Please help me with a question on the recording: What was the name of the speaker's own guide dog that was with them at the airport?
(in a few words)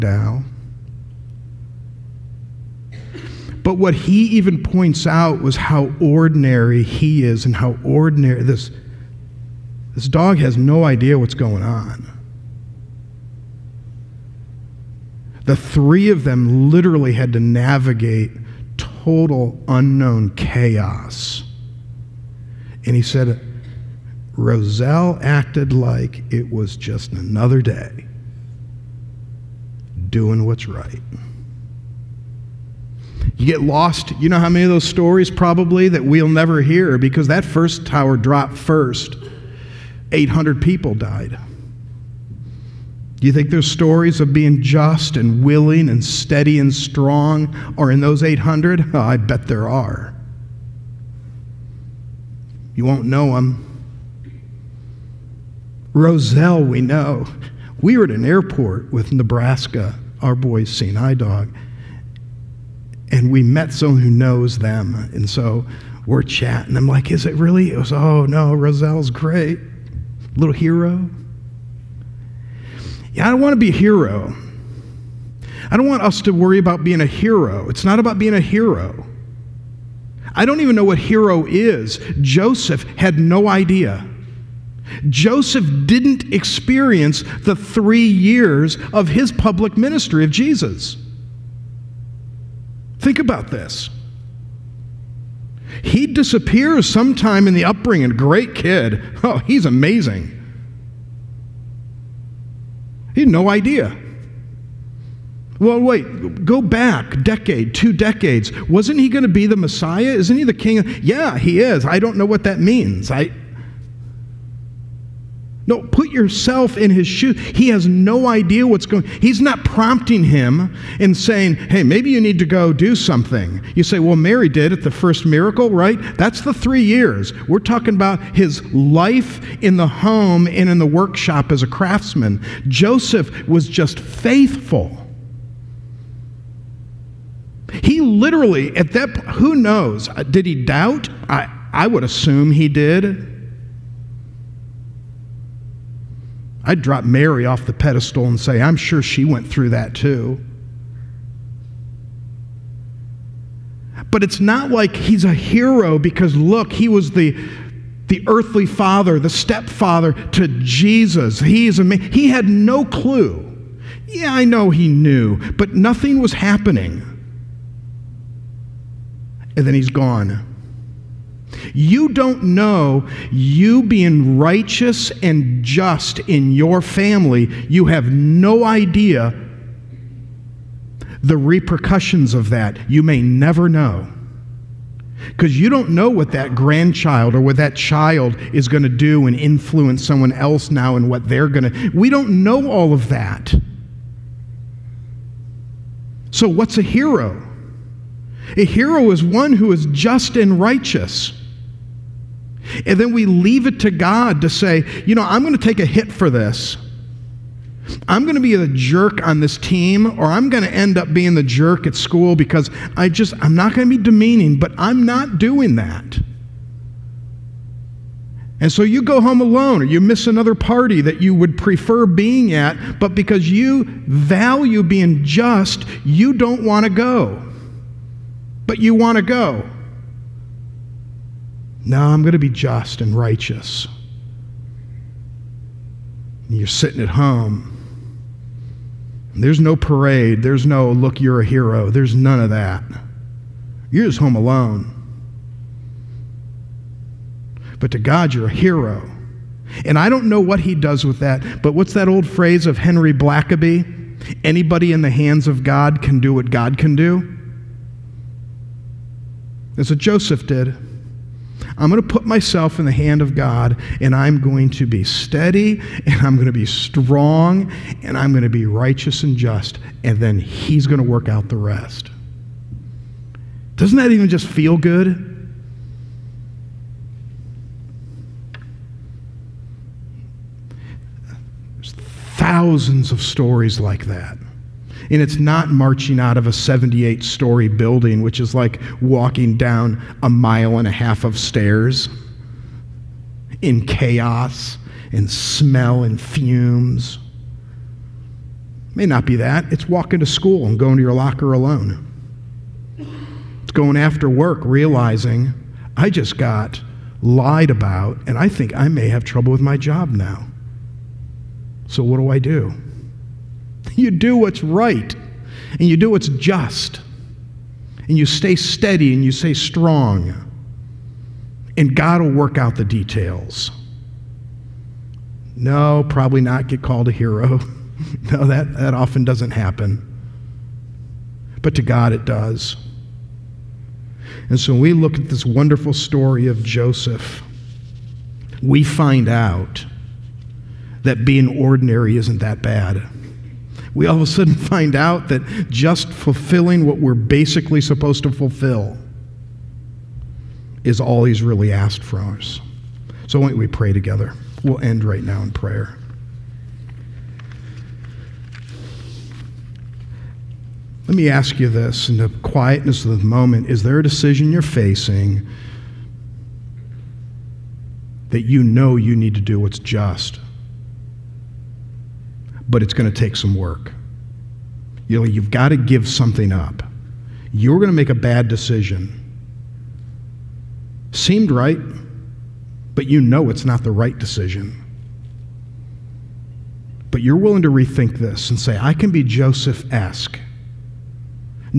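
Nebraska.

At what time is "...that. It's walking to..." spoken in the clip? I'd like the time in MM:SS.
04:59.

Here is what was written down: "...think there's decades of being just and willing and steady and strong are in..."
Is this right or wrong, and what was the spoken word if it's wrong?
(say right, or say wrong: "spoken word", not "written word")
wrong: "stories", not "decades".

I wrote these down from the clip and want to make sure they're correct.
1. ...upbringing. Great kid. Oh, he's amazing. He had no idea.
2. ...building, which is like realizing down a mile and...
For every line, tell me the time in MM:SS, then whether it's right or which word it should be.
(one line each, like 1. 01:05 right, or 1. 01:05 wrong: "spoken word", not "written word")
1. 01:37 right
2. 04:47 wrong: "walking", not "realizing".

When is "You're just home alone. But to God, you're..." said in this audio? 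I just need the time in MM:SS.
04:03.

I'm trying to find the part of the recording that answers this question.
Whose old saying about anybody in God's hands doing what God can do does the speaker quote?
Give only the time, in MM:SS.
04:12.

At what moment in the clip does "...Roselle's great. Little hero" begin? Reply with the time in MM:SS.
01:08.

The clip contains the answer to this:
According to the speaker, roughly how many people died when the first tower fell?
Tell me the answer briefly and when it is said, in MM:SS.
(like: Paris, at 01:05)
800, at 00:40.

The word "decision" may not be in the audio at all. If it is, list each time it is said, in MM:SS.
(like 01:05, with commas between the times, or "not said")
06:04, 06:18, 06:24.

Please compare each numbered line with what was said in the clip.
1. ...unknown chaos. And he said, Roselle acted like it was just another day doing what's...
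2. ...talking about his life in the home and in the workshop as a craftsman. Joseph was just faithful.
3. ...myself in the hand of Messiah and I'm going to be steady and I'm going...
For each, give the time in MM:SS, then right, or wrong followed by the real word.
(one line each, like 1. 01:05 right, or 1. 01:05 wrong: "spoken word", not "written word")
1. 00:19 right
2. 02:07 right
3. 04:22 wrong: "God", not "Messiah".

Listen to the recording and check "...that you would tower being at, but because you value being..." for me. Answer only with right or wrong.
wrong.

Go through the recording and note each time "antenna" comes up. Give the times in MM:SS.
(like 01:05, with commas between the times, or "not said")
not said.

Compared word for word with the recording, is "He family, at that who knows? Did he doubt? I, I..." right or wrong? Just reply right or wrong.
wrong.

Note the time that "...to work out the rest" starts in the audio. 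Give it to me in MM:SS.
04:31.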